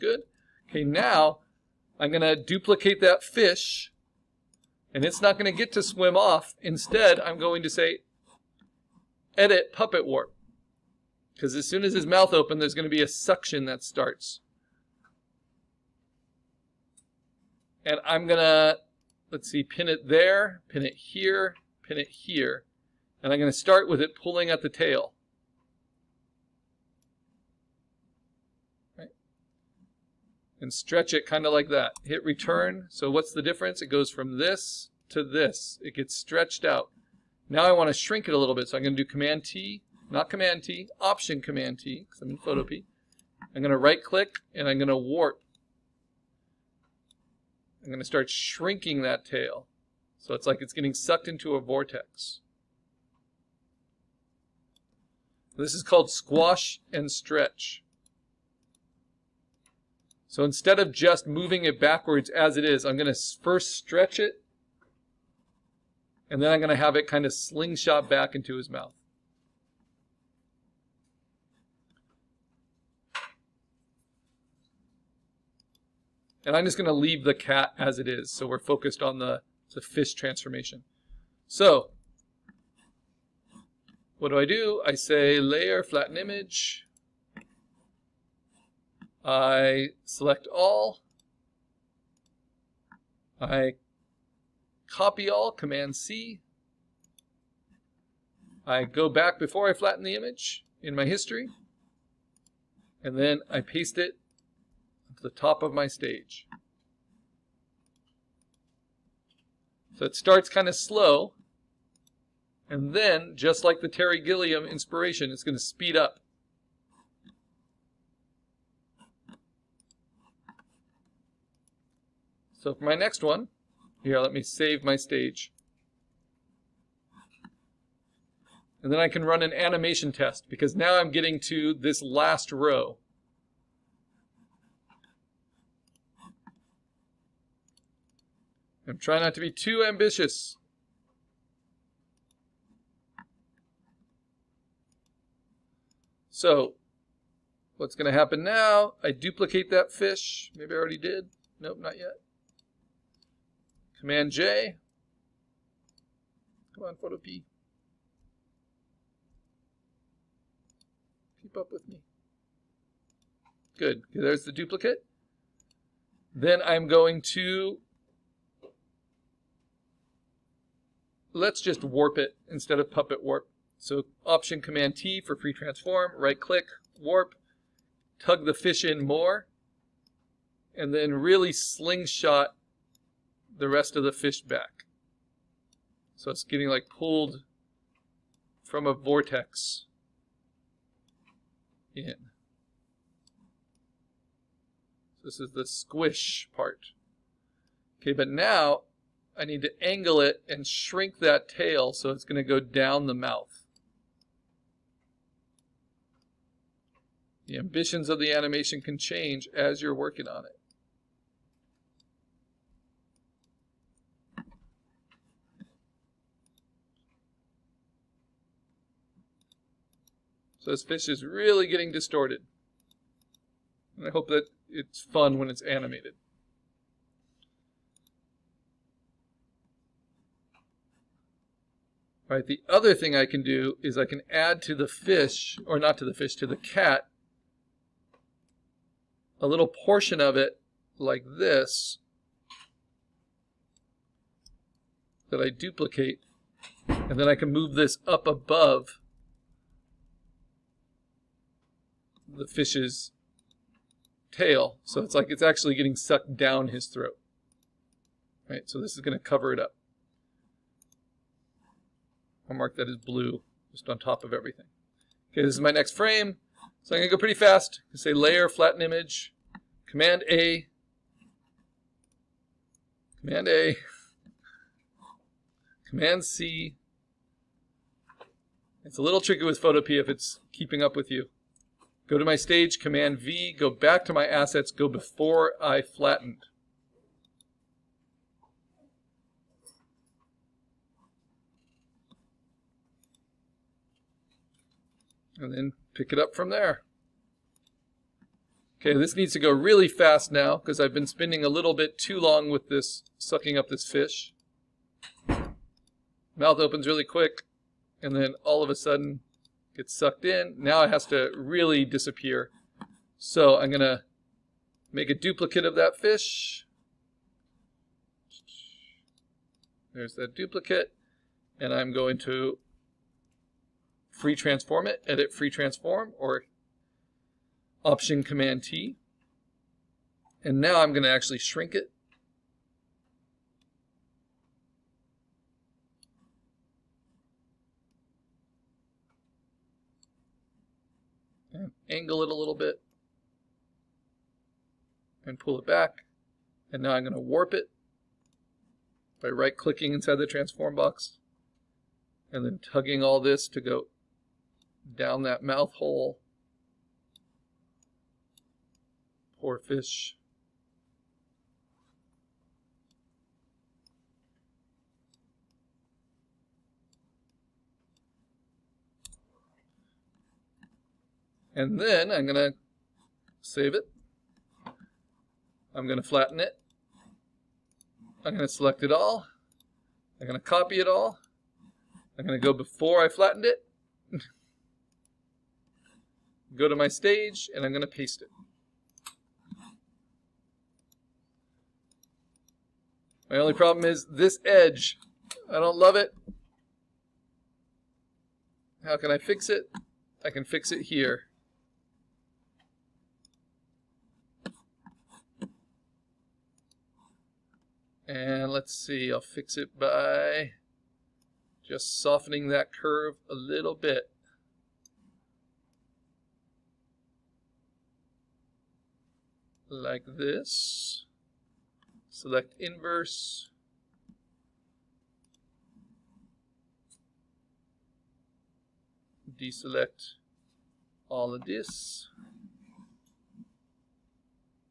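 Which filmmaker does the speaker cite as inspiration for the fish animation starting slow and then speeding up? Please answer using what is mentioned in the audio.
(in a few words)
Terry Gilliam.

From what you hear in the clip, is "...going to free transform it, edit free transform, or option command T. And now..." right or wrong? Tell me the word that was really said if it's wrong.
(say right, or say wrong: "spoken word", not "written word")
right.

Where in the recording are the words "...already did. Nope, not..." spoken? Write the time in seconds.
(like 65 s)
150 s.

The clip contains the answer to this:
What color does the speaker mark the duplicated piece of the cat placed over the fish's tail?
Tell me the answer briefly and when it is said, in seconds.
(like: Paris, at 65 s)
Blue, at 262 s.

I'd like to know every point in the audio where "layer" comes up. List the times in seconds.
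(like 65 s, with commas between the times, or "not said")
85 s, 268 s.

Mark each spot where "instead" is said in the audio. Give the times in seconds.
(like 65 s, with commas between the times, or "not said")
6 s, 60 s, 172 s.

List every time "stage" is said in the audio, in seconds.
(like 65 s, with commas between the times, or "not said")
105 s, 124 s, 282 s, 386 s.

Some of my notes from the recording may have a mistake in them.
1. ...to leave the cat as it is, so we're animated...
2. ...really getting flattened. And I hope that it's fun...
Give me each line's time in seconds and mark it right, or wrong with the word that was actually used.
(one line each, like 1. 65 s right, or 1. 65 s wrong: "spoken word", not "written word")
1. 76 s wrong: "focused", not "animated"
2. 221 s wrong: "distorted", not "flattened".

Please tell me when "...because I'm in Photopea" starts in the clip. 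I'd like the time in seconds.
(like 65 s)
42 s.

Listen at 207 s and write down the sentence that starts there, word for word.
The ambitions of the animation can change as you're working on it.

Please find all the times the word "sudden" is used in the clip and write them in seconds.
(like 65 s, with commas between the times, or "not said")
308 s.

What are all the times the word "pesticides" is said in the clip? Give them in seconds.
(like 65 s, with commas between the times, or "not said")
not said.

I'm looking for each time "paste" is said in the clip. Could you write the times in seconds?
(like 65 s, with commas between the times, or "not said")
103 s, 387 s.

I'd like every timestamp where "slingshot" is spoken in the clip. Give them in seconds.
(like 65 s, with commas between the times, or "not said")
67 s, 181 s.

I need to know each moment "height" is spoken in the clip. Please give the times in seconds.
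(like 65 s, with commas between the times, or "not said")
not said.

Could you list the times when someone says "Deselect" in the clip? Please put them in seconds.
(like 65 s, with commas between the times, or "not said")
429 s.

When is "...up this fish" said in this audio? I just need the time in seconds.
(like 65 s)
303 s.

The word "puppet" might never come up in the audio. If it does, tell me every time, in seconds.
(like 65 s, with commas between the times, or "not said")
9 s, 172 s.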